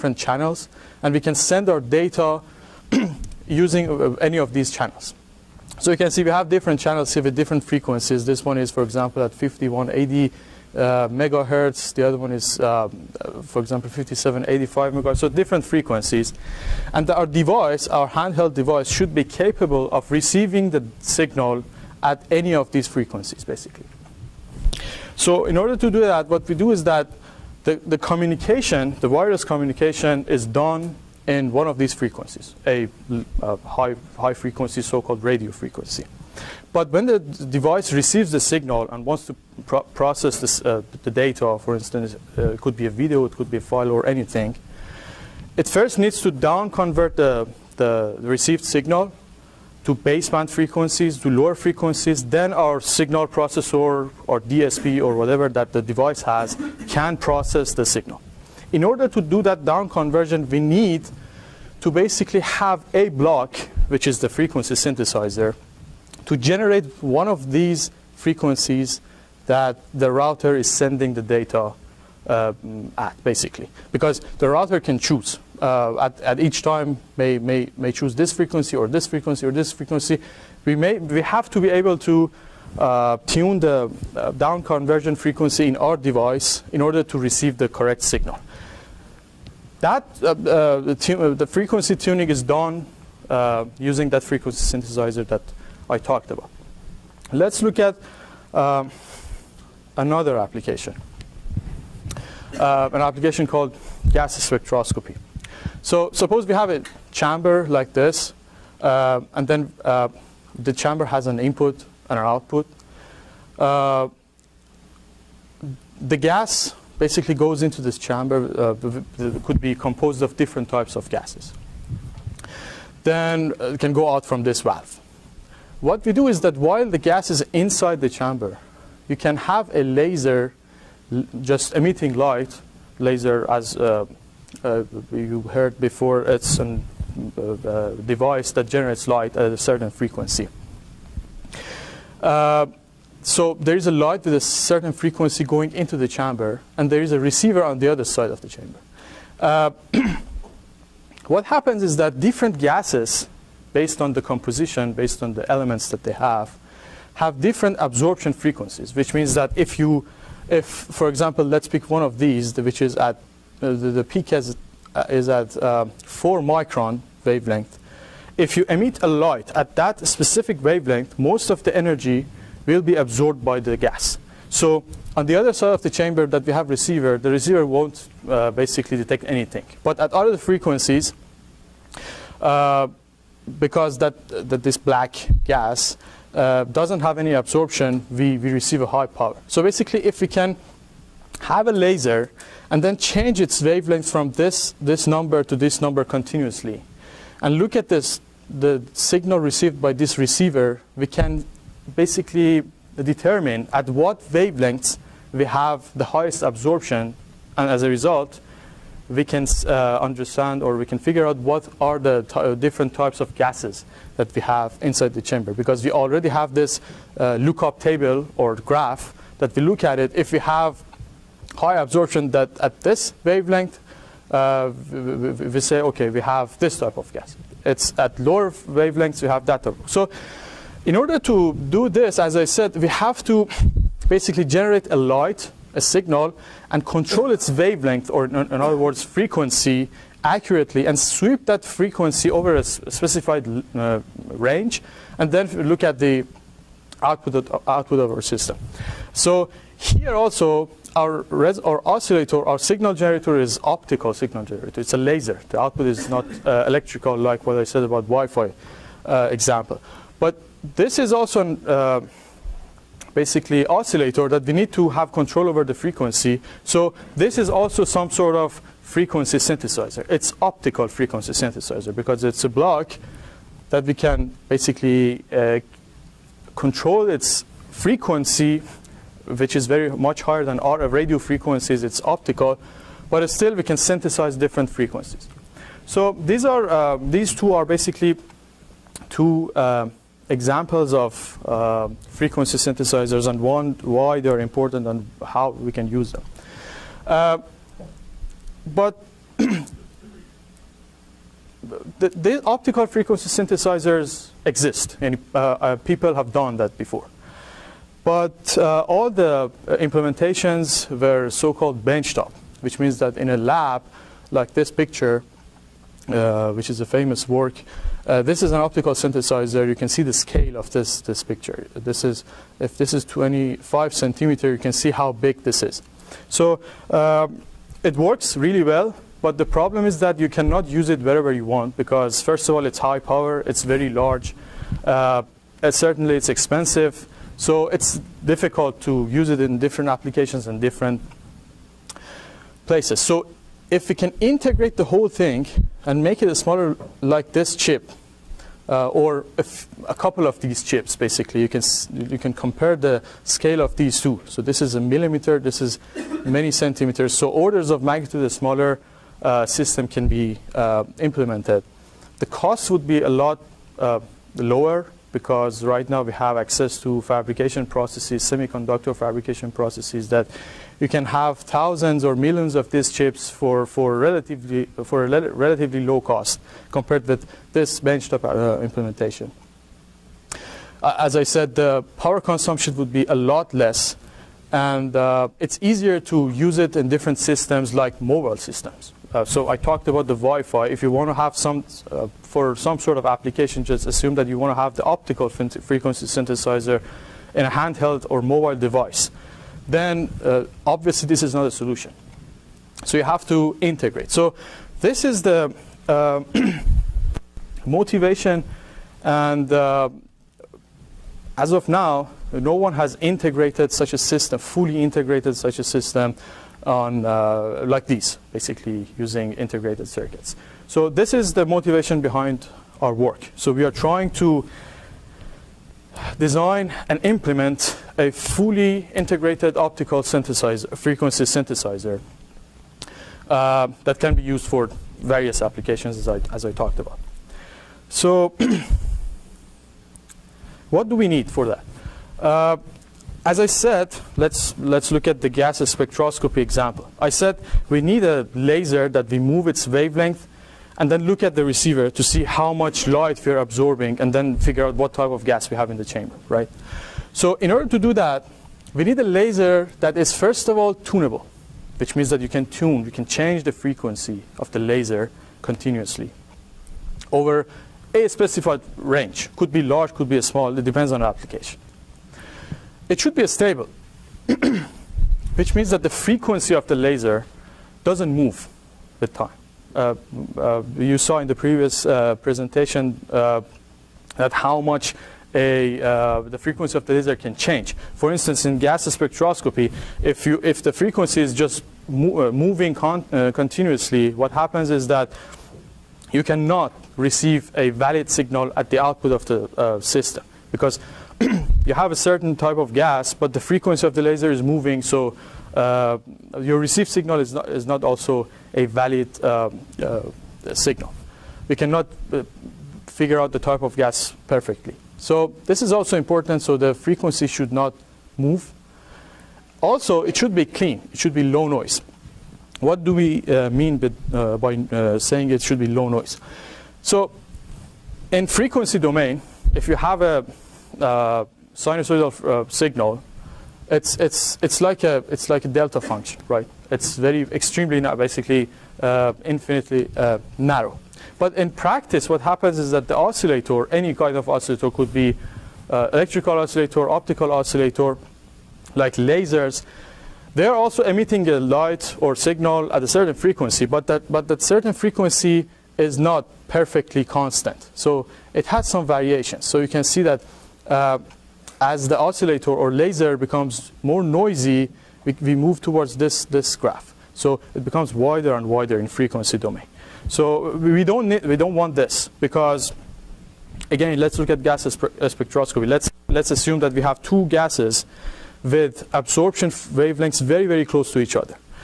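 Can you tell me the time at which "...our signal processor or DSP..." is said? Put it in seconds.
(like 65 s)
52 s.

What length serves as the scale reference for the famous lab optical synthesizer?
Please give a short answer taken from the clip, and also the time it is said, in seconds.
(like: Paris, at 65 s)
25 centimeters, at 323 s.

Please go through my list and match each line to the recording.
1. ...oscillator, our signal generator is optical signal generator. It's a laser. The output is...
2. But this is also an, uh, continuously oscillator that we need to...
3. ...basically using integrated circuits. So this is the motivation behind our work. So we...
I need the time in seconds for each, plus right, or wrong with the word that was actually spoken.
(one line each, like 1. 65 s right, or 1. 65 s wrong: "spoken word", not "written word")
1. 251 s right
2. 260 s wrong: "basically", not "continuously"
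3. 418 s right.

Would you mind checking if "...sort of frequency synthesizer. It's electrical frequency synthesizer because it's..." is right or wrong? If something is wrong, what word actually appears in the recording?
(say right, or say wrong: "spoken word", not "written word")
wrong: "optical", not "electrical".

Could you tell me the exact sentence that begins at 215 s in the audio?
Because we already have this uh, lookup table or graph that we look at it.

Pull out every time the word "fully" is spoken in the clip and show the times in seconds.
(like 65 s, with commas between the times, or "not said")
414 s, 428 s.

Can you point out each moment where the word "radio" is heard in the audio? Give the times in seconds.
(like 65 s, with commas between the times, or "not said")
35 s, 280 s.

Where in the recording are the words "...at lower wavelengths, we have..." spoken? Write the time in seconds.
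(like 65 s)
227 s.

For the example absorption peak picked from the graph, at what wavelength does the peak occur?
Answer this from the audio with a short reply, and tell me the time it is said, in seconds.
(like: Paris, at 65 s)
4 microns, at 166 s.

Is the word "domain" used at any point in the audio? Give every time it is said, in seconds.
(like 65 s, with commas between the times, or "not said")
528 s, 569 s.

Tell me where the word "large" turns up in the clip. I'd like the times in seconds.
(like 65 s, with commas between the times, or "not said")
333 s, 469 s.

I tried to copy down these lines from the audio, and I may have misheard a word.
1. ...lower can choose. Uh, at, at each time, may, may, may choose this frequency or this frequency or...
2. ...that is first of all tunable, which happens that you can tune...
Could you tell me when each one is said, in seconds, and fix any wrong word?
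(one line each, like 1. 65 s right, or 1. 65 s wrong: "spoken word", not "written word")
1. 74 s wrong: "router", not "lower"
2. 459 s wrong: "means", not "happens".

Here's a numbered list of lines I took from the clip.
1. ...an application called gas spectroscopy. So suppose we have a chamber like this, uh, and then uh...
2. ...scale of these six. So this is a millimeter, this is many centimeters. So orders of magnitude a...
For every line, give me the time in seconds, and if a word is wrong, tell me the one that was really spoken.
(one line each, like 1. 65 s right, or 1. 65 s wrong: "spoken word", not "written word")
1. 102 s right
2. 353 s wrong: "two", not "six".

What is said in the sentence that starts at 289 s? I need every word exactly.
Uh, examples of uh, frequency synthesizers and one, why they're important and how we can use them.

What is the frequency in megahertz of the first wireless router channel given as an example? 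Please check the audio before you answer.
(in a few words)
5180 MHz.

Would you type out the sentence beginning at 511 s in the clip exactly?
We cannot uh, figure out the type of gas perfectly.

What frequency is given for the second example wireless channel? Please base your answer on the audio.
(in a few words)
5785 MHz.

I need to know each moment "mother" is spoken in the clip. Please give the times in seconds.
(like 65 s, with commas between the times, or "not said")
not said.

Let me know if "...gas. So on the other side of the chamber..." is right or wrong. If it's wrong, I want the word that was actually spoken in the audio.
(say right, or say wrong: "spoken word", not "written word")
right.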